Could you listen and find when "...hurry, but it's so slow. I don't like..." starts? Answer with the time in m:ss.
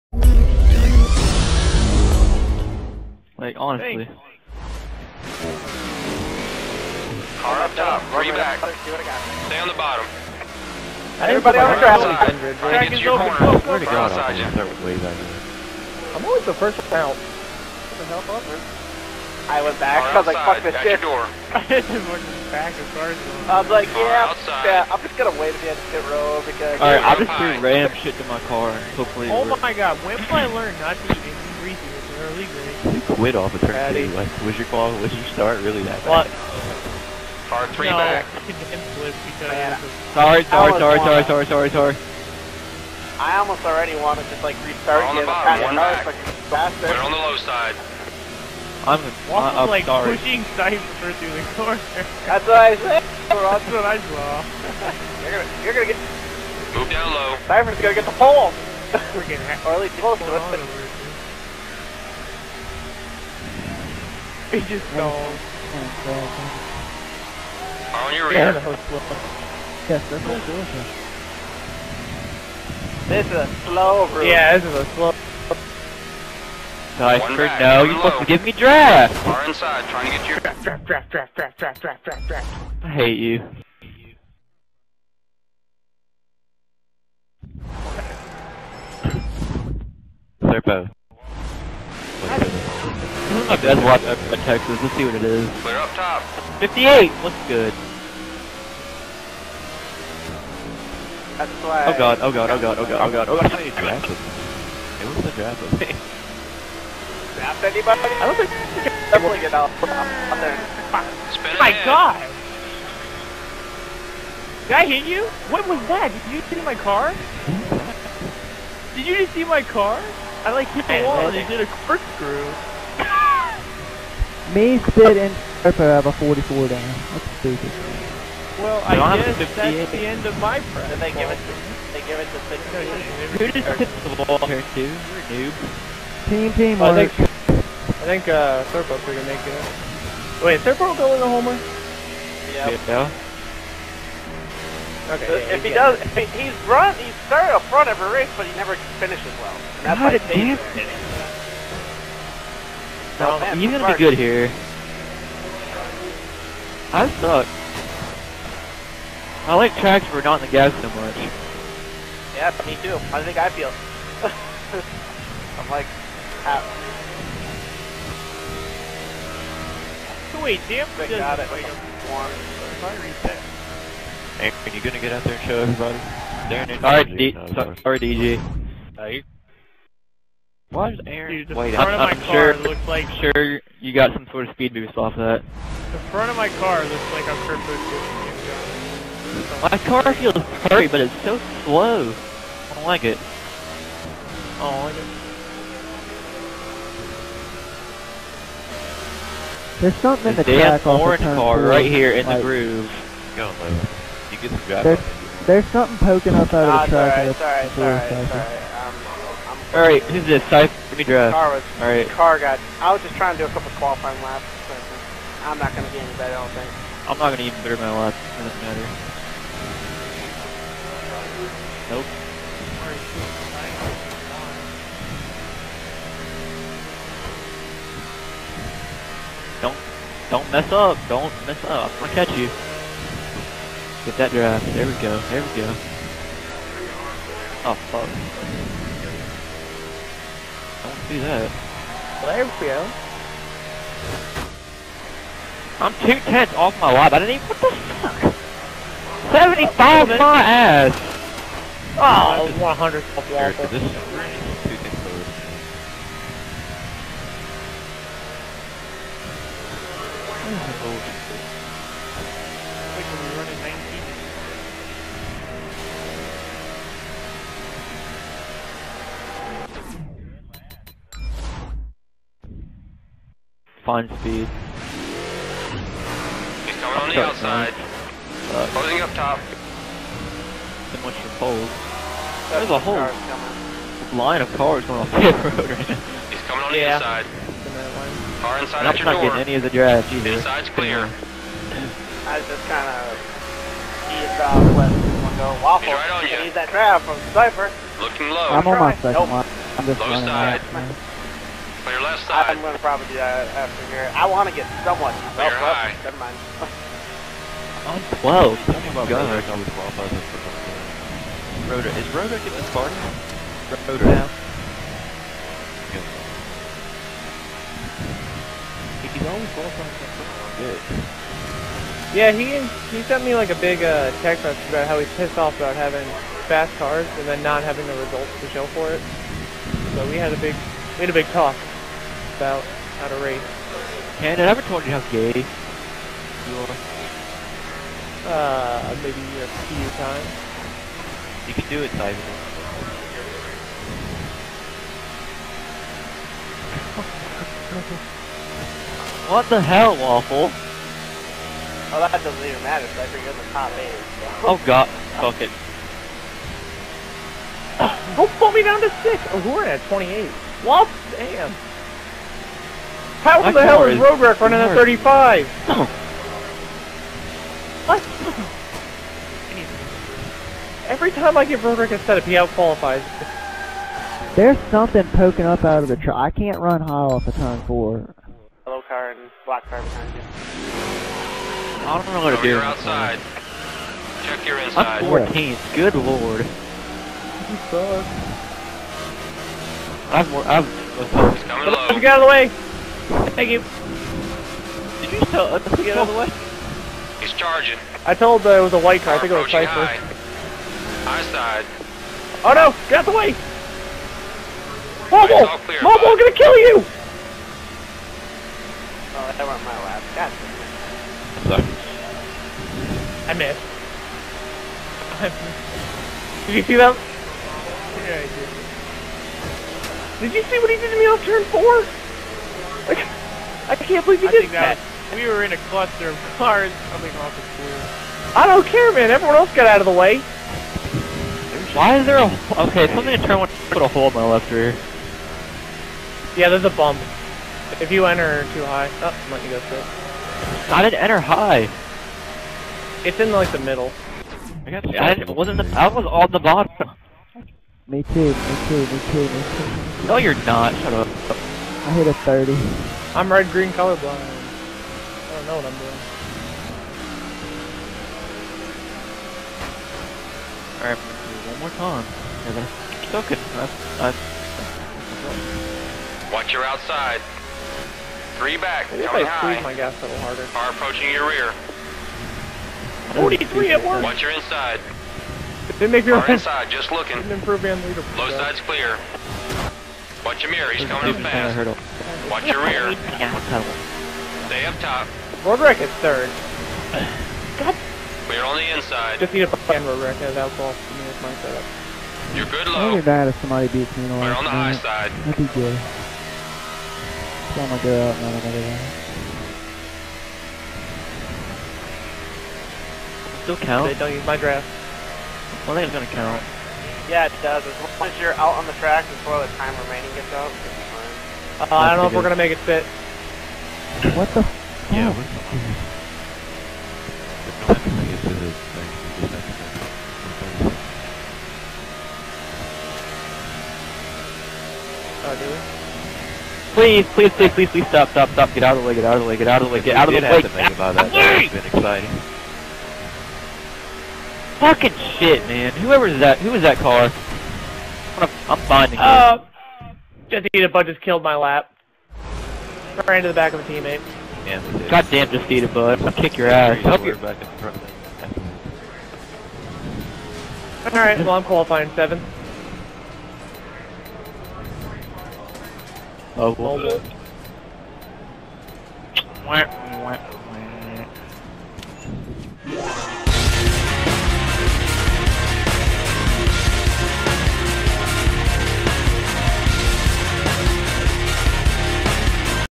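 3:10.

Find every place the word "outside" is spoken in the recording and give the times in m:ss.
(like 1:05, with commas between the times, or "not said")
4:37, 6:22, 7:46.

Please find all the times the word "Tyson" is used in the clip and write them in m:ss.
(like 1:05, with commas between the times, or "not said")
5:41.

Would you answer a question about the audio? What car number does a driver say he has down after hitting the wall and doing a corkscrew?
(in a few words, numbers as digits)
44.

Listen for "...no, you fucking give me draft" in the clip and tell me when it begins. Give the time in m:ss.
1:17.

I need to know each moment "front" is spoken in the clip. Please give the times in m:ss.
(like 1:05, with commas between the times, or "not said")
2:27, 3:06, 9:07.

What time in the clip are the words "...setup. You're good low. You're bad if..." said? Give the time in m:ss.
8:11.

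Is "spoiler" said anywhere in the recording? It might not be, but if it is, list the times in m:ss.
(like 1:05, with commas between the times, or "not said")
not said.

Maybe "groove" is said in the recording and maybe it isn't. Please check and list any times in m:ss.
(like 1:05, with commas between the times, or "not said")
3:22.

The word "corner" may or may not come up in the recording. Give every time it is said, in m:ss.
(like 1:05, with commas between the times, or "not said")
0:13, 0:51.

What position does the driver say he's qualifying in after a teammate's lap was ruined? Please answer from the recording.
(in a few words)
7.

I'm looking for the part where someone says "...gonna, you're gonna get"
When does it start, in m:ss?
0:55.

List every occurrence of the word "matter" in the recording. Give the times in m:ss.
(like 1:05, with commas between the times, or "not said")
3:38, 5:52.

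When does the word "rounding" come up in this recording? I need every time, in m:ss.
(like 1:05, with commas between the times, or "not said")
not said.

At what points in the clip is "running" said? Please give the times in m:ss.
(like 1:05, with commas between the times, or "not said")
5:00, 6:04.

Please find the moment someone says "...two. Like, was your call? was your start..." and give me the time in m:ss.
0:33.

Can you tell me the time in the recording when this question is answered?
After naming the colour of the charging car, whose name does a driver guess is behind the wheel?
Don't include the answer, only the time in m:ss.
6:39.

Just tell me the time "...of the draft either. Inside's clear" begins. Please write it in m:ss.
4:49.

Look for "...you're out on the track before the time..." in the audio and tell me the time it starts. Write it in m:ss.
8:28.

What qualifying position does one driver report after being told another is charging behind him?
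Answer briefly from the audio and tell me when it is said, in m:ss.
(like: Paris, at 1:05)
14th, at 6:25.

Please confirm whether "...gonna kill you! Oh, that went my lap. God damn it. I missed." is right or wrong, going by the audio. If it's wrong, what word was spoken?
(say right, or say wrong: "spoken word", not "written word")
right.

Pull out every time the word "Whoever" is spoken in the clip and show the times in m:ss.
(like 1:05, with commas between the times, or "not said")
8:55.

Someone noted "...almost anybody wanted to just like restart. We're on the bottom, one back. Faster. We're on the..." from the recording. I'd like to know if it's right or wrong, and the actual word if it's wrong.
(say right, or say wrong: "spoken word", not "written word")
wrong: "already", not "anybody".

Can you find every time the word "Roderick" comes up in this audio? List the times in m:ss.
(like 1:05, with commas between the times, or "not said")
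8:05, 8:09.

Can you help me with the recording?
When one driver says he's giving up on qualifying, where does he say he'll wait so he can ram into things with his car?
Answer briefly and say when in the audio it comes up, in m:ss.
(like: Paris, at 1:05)
End of pit row, at 0:25.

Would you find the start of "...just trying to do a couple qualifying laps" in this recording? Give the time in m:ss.
3:33.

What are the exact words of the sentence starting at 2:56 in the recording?
Darren All right, D so, sorry, DG.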